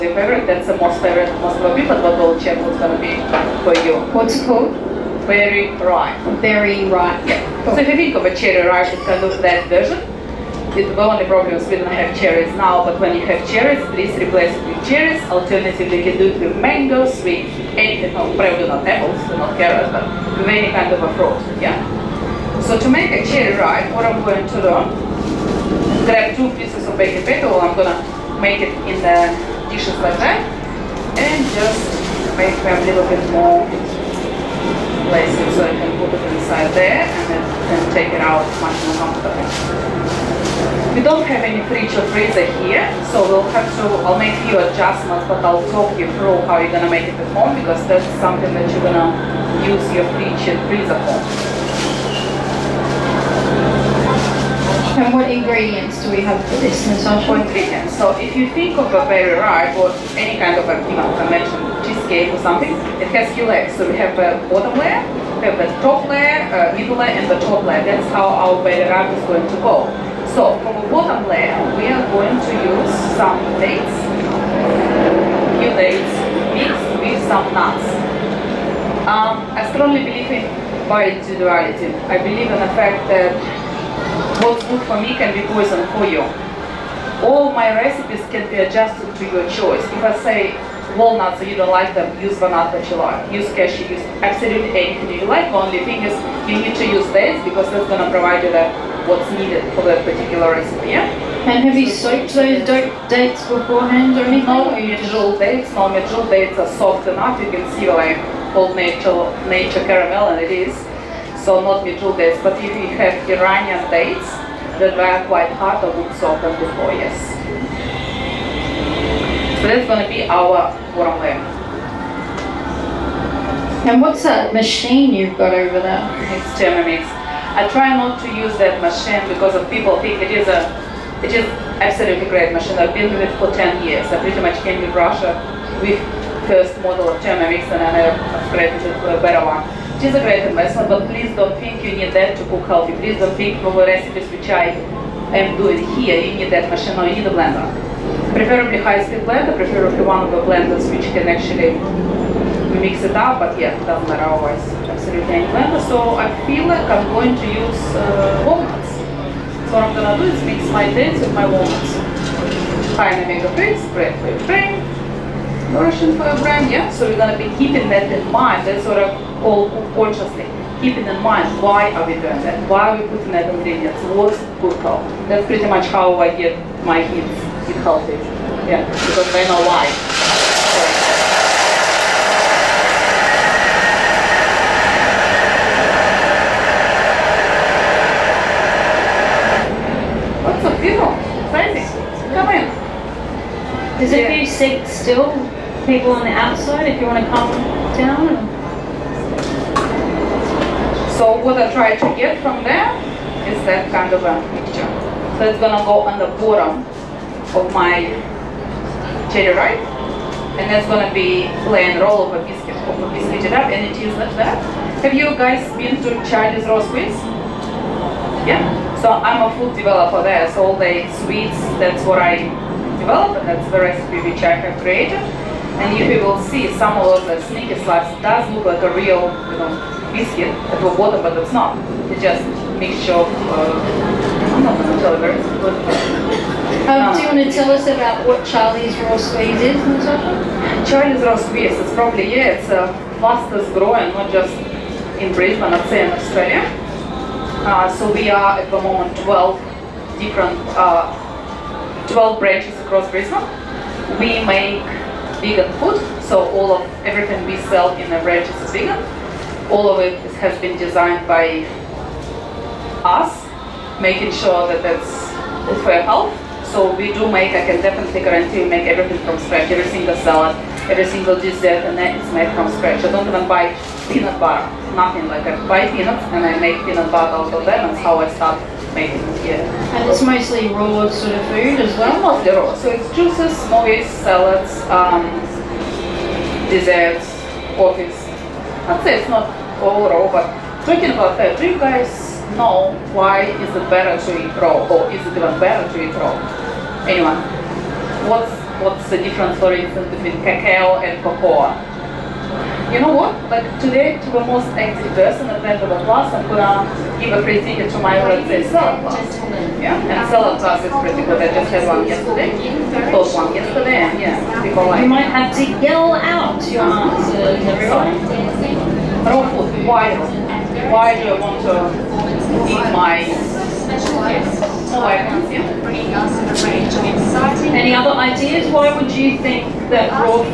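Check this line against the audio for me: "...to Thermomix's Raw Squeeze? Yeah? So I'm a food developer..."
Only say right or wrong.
wrong.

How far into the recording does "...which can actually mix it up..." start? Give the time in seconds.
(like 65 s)
150 s.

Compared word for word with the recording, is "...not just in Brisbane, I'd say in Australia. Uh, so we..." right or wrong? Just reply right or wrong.
right.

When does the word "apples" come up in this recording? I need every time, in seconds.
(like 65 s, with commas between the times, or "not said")
18 s.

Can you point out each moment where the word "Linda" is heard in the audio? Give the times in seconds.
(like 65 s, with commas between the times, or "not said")
not said.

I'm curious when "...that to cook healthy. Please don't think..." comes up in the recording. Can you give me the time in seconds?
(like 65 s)
142 s.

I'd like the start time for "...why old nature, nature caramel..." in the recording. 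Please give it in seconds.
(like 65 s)
107 s.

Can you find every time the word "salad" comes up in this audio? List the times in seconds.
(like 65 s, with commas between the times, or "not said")
270 s, 284 s, 310 s.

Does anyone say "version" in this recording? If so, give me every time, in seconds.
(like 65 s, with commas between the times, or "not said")
9 s.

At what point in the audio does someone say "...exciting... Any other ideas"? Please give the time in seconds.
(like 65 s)
327 s.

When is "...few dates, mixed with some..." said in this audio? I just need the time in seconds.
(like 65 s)
75 s.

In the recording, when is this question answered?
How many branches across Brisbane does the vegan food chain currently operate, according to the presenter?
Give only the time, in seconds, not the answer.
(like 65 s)
252 s.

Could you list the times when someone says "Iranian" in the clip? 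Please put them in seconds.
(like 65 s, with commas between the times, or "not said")
113 s.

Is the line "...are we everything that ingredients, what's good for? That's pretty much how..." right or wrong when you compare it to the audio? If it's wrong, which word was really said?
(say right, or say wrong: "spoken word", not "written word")
wrong: "putting", not "everything".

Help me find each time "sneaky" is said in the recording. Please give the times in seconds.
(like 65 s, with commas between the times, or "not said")
227 s.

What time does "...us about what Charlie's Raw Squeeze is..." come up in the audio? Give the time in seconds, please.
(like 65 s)
237 s.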